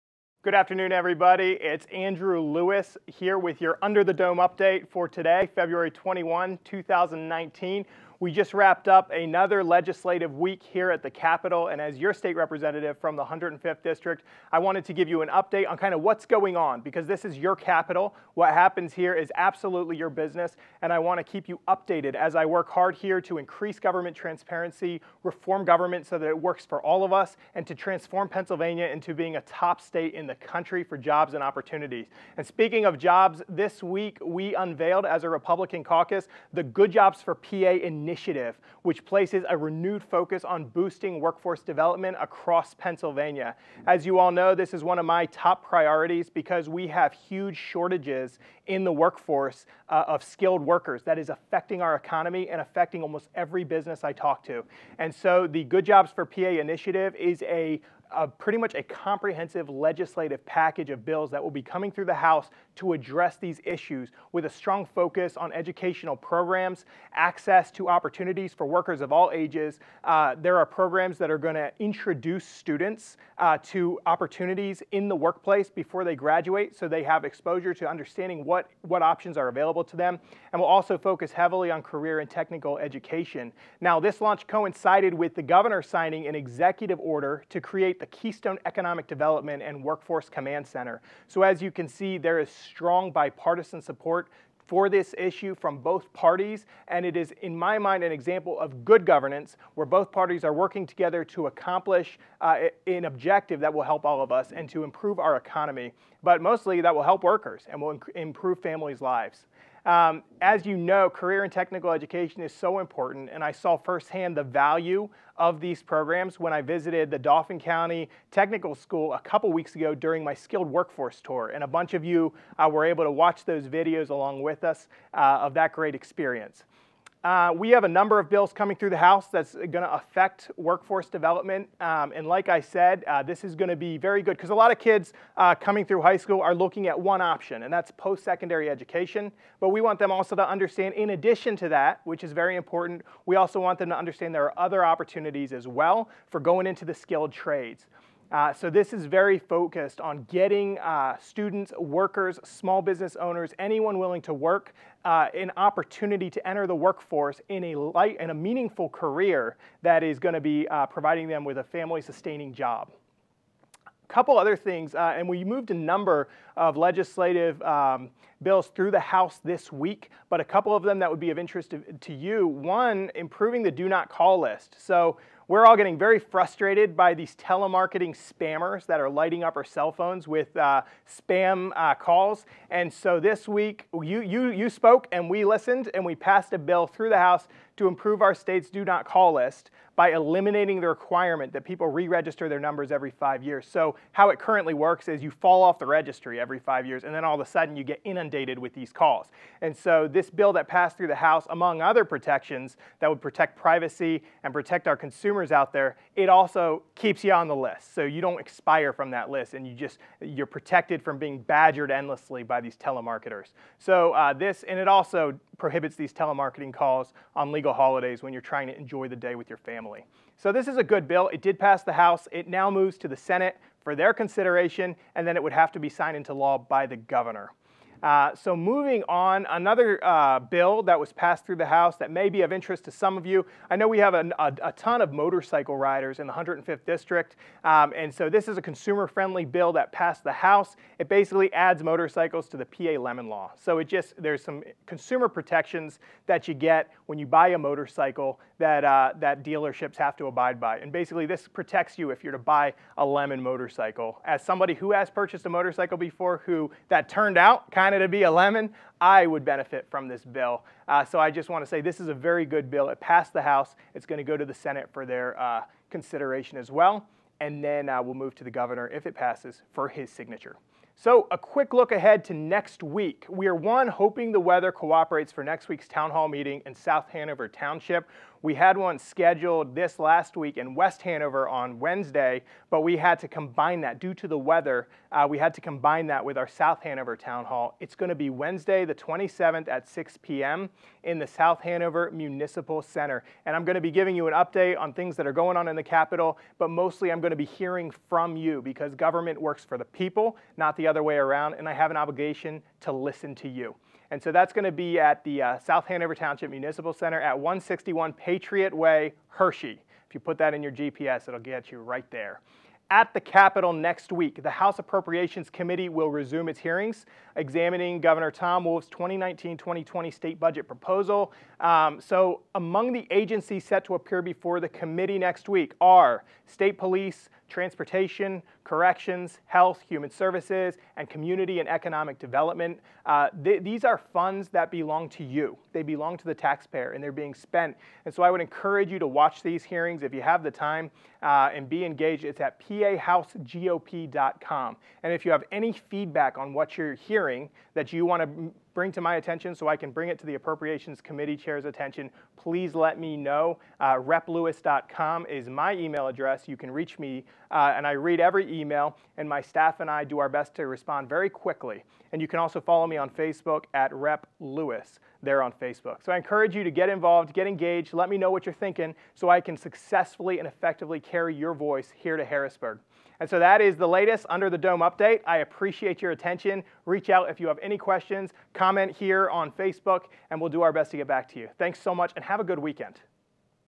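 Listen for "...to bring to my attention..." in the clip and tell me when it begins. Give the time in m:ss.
5:48.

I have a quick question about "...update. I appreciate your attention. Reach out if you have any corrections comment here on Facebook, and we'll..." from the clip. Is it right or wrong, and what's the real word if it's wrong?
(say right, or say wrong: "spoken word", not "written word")
wrong: "questions", not "corrections".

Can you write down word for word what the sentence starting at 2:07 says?
Uh, we have a number of bills coming through the House that's going to affect workforce development.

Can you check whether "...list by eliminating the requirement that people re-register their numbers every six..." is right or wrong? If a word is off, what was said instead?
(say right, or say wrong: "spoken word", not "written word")
wrong: "five", not "six".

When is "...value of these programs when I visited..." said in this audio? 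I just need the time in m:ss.
1:54.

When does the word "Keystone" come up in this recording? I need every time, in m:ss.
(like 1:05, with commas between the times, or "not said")
1:28.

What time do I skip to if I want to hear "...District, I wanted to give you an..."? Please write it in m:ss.
0:13.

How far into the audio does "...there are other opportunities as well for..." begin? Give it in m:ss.
2:24.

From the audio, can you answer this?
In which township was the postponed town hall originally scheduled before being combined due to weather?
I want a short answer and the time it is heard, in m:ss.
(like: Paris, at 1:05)
West Hanover, at 4:40.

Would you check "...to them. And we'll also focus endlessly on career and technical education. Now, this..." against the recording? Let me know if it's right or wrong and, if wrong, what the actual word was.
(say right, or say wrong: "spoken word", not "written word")
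wrong: "heavily", not "endlessly".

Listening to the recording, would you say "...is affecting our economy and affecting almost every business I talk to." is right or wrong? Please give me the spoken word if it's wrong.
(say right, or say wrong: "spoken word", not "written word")
right.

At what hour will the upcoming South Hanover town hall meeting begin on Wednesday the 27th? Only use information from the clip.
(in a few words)
6 p.m.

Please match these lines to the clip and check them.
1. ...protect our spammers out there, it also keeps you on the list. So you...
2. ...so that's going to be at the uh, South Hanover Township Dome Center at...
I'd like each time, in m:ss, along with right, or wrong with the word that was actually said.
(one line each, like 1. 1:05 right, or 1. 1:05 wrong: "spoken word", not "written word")
1. 3:24 wrong: "consumers", not "spammers"
2. 5:04 wrong: "Municipal", not "Dome".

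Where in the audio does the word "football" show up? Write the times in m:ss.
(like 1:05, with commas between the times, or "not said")
not said.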